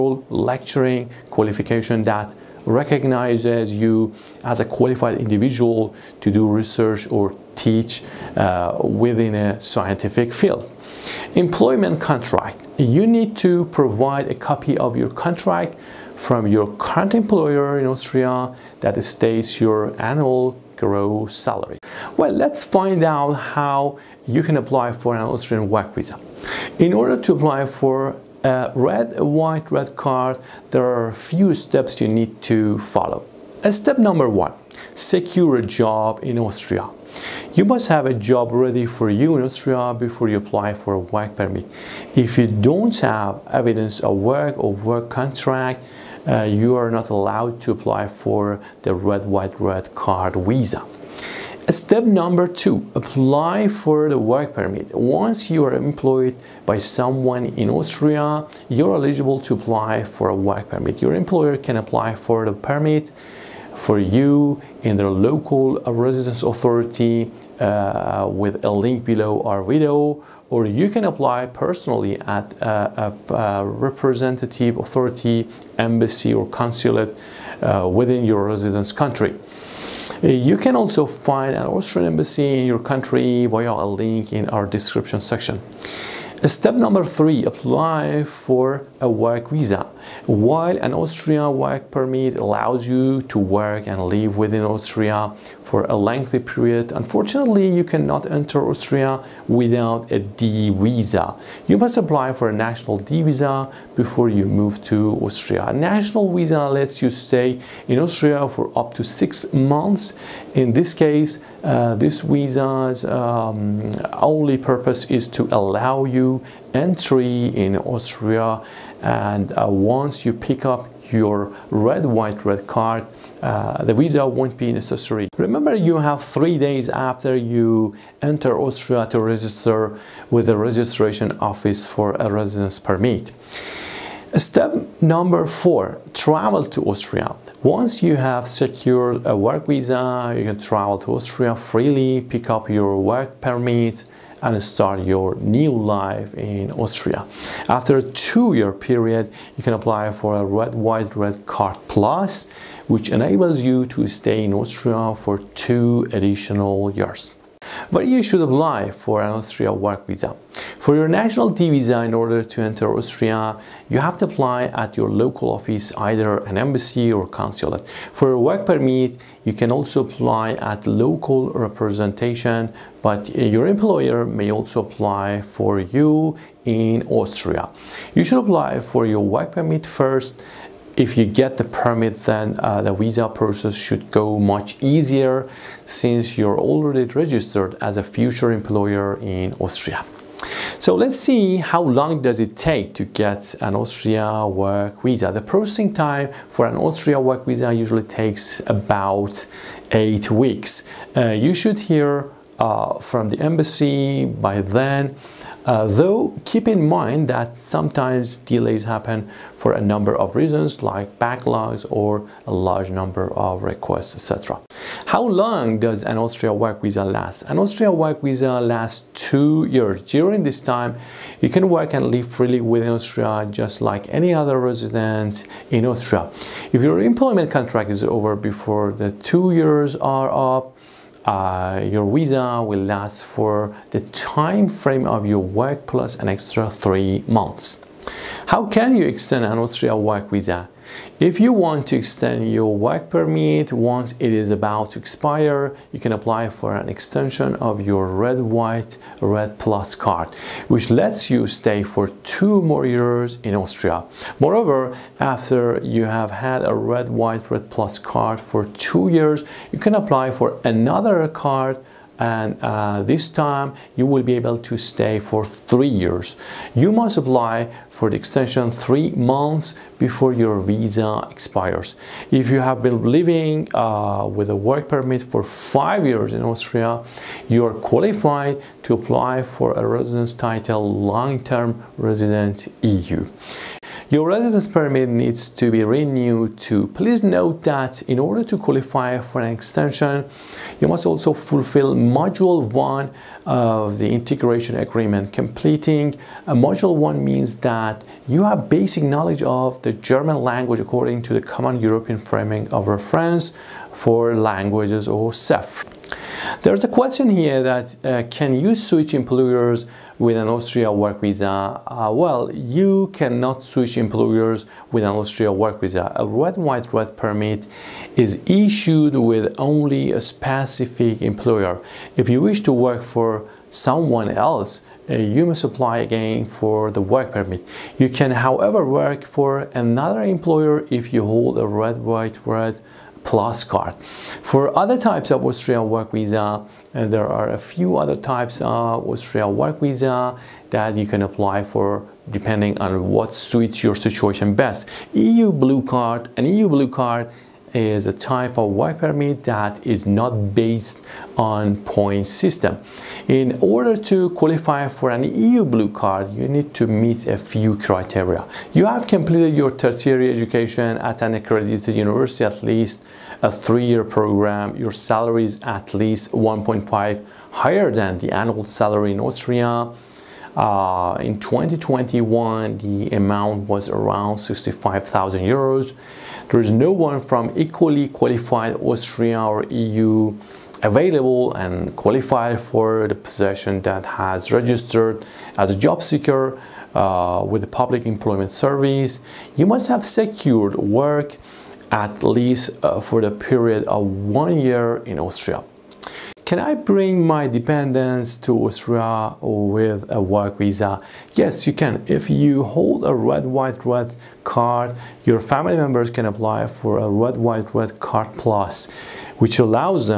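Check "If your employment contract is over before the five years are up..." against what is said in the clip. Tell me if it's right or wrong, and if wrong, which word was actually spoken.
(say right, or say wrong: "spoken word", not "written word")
wrong: "two", not "five".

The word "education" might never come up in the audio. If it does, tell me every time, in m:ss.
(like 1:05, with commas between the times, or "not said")
6:00.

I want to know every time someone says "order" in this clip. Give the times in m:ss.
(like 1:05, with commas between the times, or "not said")
0:26, 2:42, 4:48, 5:53.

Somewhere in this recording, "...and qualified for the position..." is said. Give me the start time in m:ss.
6:21.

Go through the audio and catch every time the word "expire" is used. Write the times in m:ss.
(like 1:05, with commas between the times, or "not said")
4:04, 4:31.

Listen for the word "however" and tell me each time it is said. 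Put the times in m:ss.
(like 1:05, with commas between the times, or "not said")
5:28.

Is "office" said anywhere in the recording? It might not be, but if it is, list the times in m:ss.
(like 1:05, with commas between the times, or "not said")
2:11, 2:45.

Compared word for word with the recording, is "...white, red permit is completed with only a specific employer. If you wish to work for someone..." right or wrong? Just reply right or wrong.
wrong.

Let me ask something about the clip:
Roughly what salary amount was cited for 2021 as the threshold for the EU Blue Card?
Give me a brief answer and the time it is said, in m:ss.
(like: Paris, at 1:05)
65,000 euros, at 6:14.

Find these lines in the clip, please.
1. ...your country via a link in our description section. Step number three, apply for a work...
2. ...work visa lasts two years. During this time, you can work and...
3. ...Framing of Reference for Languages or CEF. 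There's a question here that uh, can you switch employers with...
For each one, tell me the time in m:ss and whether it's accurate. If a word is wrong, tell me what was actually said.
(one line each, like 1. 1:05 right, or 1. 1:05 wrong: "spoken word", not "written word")
1. 1:22 right
2. 3:37 right
3. 5:02 right.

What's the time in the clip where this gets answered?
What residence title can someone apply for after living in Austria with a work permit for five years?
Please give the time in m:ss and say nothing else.
4:41.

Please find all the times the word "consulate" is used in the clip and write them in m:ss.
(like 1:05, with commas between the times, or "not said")
1:16, 2:47.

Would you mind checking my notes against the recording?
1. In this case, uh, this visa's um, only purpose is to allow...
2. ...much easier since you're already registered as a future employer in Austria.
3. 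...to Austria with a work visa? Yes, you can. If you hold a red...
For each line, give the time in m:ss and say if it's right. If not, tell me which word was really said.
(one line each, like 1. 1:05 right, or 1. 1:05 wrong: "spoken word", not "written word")
1. 1:50 right
2. 3:04 right
3. 6:38 right.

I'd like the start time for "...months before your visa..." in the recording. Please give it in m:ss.
4:29.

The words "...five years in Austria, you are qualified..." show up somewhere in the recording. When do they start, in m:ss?
4:35.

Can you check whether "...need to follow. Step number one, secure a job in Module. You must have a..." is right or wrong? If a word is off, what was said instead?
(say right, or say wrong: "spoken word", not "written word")
wrong: "Austria", not "Module".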